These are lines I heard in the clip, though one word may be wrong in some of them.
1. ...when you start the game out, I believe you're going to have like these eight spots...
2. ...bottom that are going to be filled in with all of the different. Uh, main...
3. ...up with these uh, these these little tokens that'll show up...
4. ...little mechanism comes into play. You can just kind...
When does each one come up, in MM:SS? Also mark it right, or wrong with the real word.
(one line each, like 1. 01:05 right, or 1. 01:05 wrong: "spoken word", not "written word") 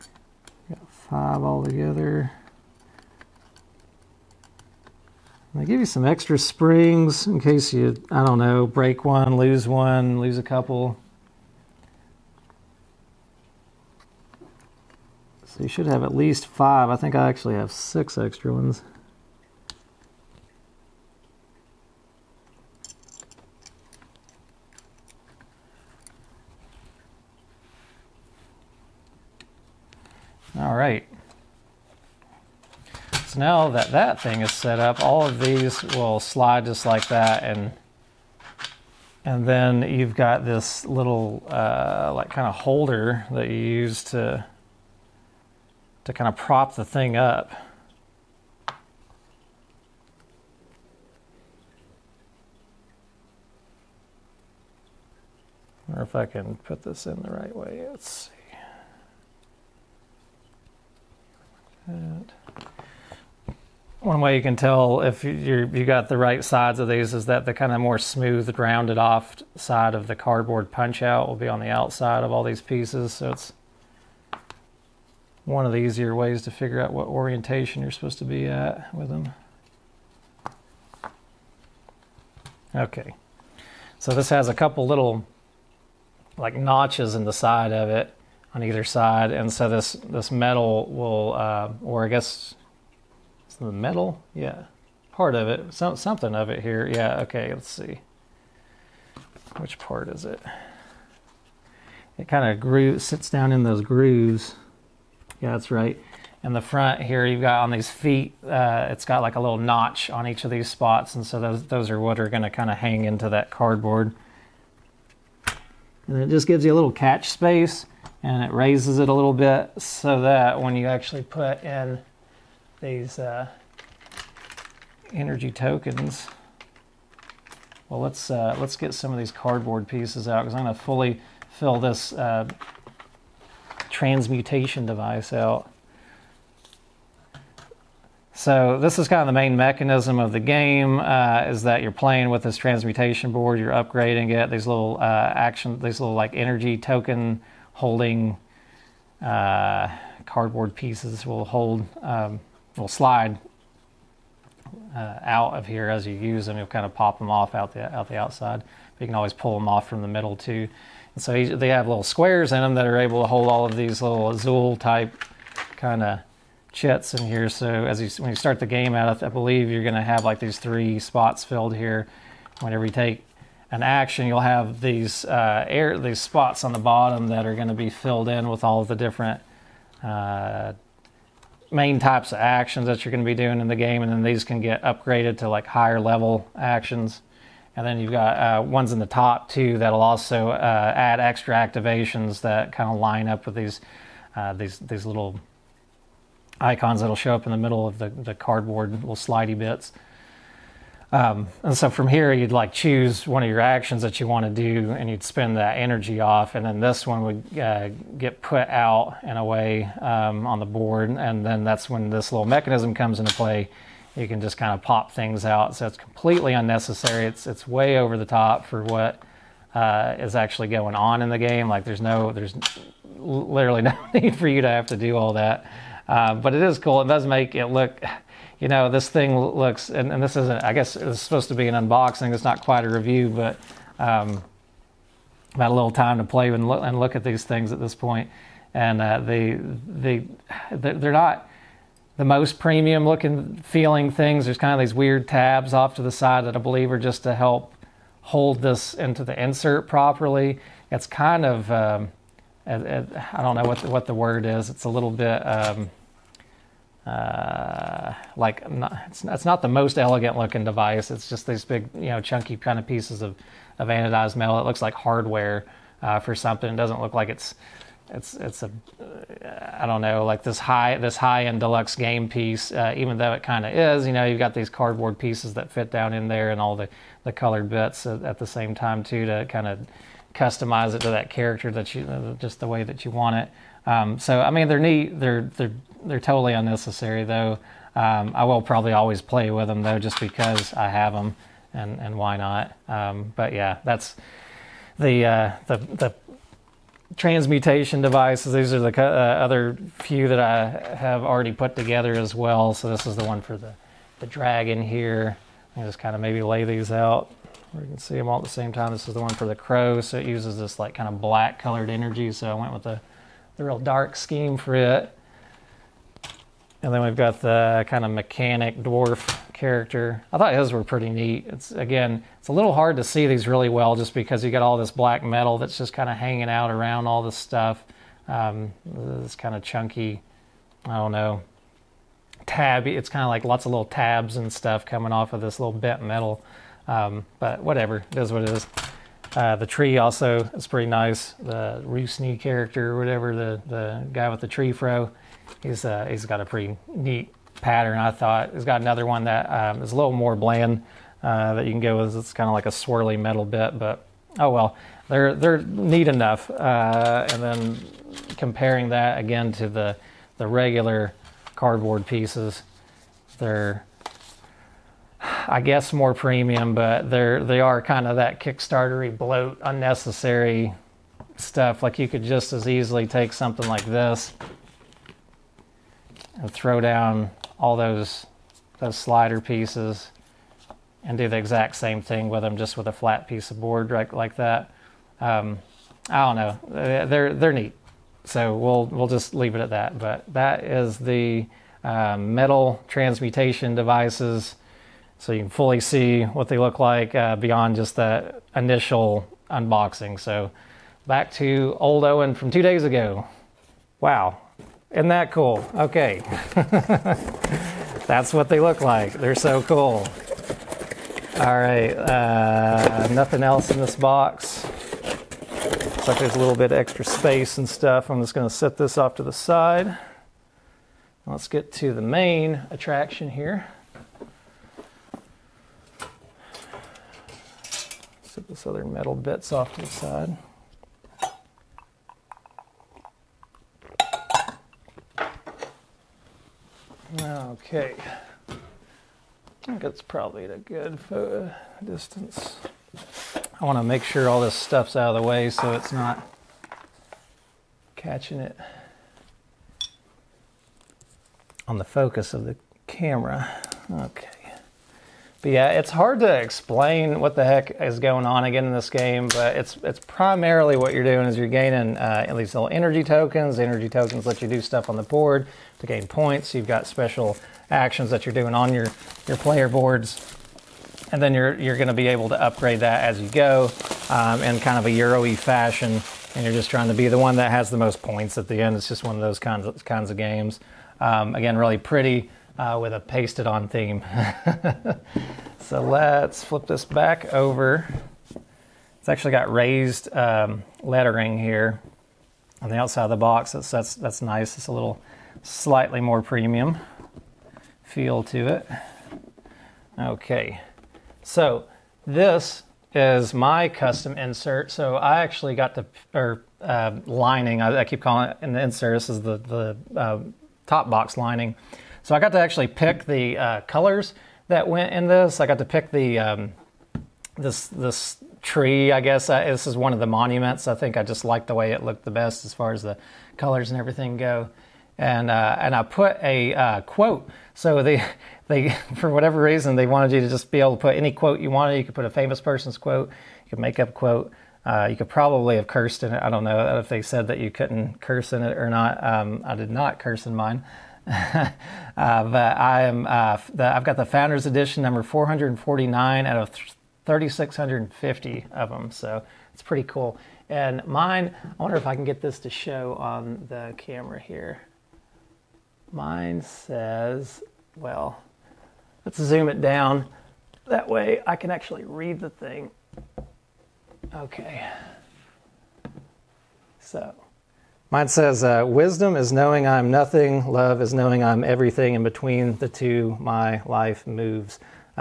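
1. 02:48 wrong: "three", not "eight"
2. 02:56 right
3. 03:13 wrong: "icons", not "tokens"
4. 03:32 right.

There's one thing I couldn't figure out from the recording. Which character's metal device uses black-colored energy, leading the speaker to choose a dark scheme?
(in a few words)
The crow.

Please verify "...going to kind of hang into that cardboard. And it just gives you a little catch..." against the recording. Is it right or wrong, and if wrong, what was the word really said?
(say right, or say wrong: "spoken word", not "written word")
right.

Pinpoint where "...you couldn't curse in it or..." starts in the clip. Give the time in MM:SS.
08:57.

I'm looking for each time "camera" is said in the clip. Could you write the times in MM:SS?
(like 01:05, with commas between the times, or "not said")
07:32, 09:13.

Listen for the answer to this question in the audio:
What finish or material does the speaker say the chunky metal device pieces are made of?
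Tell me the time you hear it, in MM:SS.
04:23.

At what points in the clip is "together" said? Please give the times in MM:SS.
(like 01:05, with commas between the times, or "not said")
00:01, 05:01.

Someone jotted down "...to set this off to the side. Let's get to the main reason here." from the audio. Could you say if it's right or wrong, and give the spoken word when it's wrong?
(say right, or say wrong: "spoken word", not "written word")
wrong: "attraction", not "reason".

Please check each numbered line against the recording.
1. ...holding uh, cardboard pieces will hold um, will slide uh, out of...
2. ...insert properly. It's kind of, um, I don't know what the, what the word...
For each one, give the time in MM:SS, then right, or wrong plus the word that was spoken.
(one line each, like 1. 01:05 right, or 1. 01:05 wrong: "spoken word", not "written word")
1. 02:27 right
2. 04:09 right.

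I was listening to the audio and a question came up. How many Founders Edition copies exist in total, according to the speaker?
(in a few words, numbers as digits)
3,650.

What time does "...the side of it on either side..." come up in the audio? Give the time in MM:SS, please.
01:27.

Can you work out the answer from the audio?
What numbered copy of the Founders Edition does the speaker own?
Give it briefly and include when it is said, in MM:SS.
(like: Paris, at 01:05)
449, at 09:05.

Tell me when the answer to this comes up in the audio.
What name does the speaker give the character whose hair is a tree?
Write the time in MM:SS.
05:41.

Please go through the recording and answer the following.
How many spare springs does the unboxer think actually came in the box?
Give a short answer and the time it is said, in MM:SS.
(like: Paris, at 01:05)
6, at 00:17.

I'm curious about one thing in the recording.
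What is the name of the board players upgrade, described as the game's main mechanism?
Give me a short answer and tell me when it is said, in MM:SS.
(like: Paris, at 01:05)
Transmutation board, at 02:22.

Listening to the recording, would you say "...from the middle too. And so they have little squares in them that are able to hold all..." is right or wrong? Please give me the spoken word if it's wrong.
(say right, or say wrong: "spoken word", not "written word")
right.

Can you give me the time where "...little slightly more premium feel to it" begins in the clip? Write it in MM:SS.
08:14.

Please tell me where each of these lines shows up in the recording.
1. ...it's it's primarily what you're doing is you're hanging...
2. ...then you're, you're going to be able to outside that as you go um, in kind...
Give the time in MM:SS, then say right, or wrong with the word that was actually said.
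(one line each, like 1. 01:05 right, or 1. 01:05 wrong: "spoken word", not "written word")
1. 07:39 wrong: "gaining", not "hanging"
2. 07:51 wrong: "upgrade", not "outside".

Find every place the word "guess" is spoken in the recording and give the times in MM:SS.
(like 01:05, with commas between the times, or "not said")
01:32, 03:50, 06:05, 08:38.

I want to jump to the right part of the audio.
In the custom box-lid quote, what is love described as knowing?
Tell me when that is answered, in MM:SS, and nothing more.
09:31.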